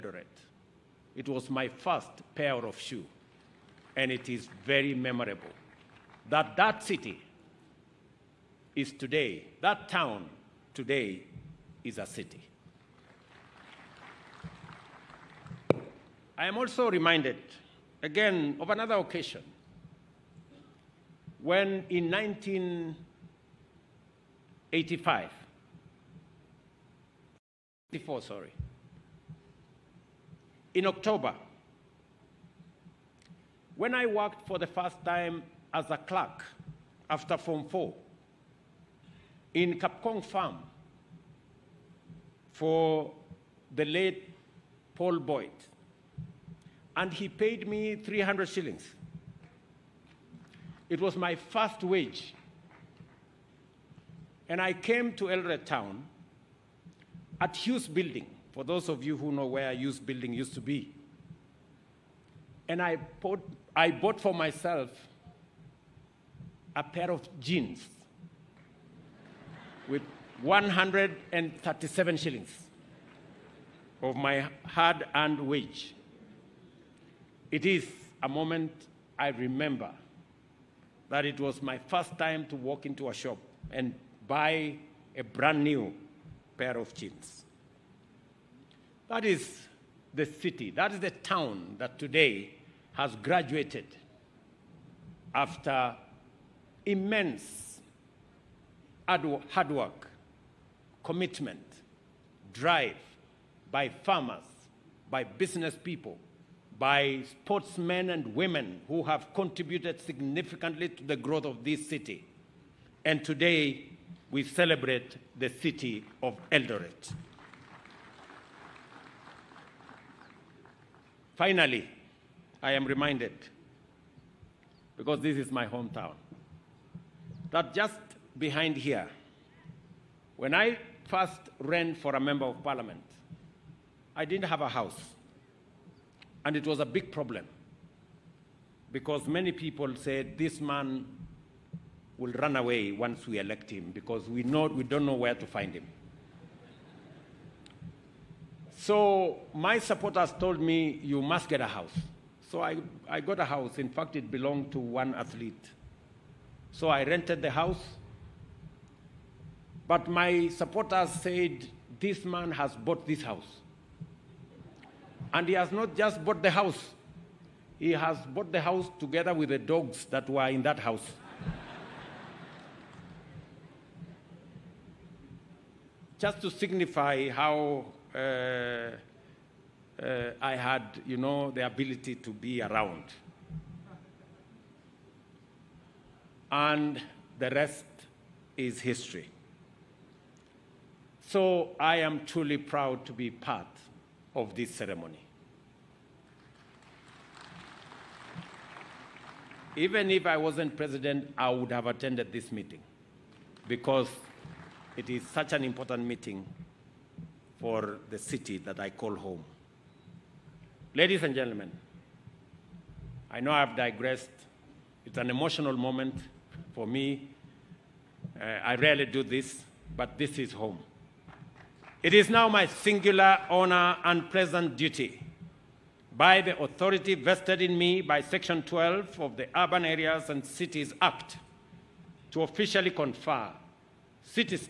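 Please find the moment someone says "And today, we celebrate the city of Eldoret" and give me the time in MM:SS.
01:53.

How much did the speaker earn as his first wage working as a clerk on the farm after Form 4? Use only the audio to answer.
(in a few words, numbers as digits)
300 shillings.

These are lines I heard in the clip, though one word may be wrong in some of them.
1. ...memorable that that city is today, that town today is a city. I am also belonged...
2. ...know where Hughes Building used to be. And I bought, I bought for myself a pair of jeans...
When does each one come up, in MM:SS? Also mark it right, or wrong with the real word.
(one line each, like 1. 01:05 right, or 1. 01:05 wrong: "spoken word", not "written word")
1. 00:04 wrong: "reminded", not "belonged"
2. 00:59 right.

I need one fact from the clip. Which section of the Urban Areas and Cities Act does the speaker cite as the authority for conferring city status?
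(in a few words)
Section 12.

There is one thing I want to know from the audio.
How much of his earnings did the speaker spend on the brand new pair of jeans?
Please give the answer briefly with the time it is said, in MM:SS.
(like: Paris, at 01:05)
137 shillings, at 01:10.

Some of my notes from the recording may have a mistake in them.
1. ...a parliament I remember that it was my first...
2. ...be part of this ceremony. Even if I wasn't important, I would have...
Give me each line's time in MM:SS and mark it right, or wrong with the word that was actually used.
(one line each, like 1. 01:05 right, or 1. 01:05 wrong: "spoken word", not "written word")
1. 01:18 wrong: "moment", not "parliament"
2. 03:13 wrong: "president", not "important".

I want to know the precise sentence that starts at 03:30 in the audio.
Ladies and gentlemen, I know I've digressed.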